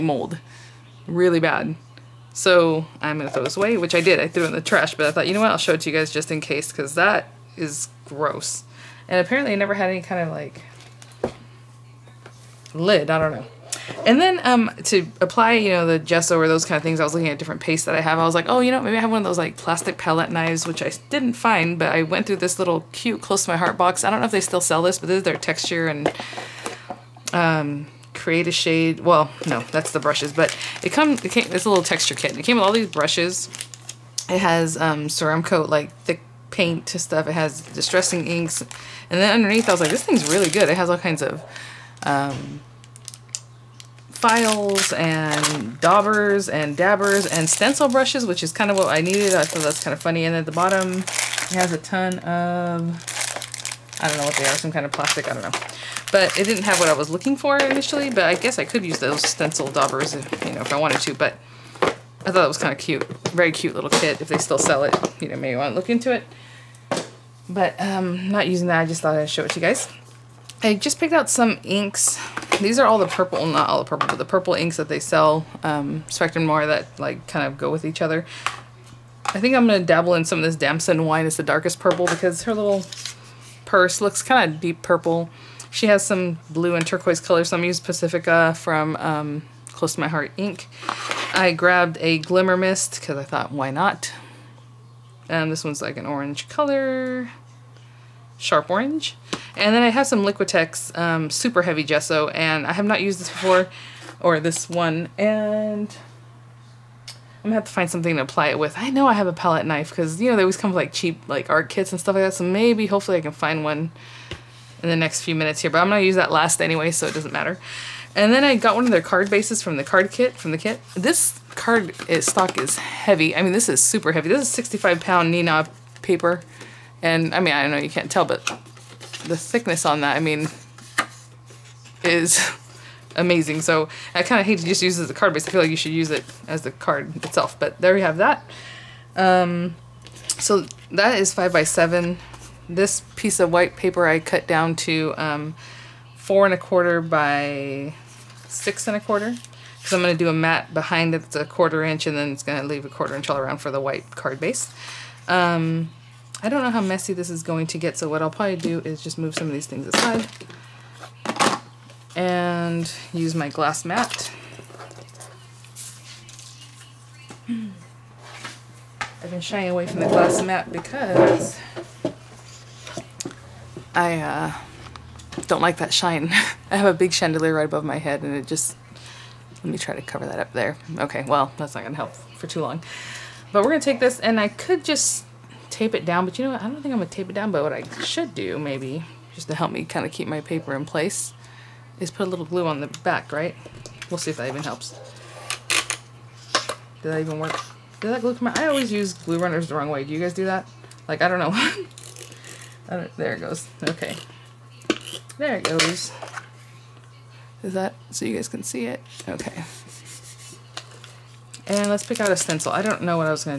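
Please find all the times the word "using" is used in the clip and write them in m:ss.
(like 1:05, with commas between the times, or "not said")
1:08, 1:27.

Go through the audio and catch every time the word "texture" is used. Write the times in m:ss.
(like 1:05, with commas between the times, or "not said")
0:25, 0:31.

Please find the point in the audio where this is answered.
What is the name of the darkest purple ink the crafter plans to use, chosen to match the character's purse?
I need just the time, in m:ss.
1:20.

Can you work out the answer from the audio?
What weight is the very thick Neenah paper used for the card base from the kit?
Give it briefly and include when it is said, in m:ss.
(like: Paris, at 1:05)
65 pound, at 2:04.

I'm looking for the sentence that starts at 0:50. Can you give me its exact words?
And at the bottom, it has a ton of I don't know what they are, some kind of plastic, I don't know.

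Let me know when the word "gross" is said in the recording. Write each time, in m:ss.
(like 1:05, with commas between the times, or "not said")
0:08.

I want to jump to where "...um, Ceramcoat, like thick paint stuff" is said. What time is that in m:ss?
0:34.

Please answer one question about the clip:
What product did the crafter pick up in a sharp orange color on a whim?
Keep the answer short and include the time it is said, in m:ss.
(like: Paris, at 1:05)
Glimmer Mist, at 1:32.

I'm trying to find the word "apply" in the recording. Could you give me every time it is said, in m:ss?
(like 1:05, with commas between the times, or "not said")
0:15, 1:48.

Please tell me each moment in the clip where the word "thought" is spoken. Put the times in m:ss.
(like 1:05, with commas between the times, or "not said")
0:05, 0:49, 1:02, 1:09, 1:33.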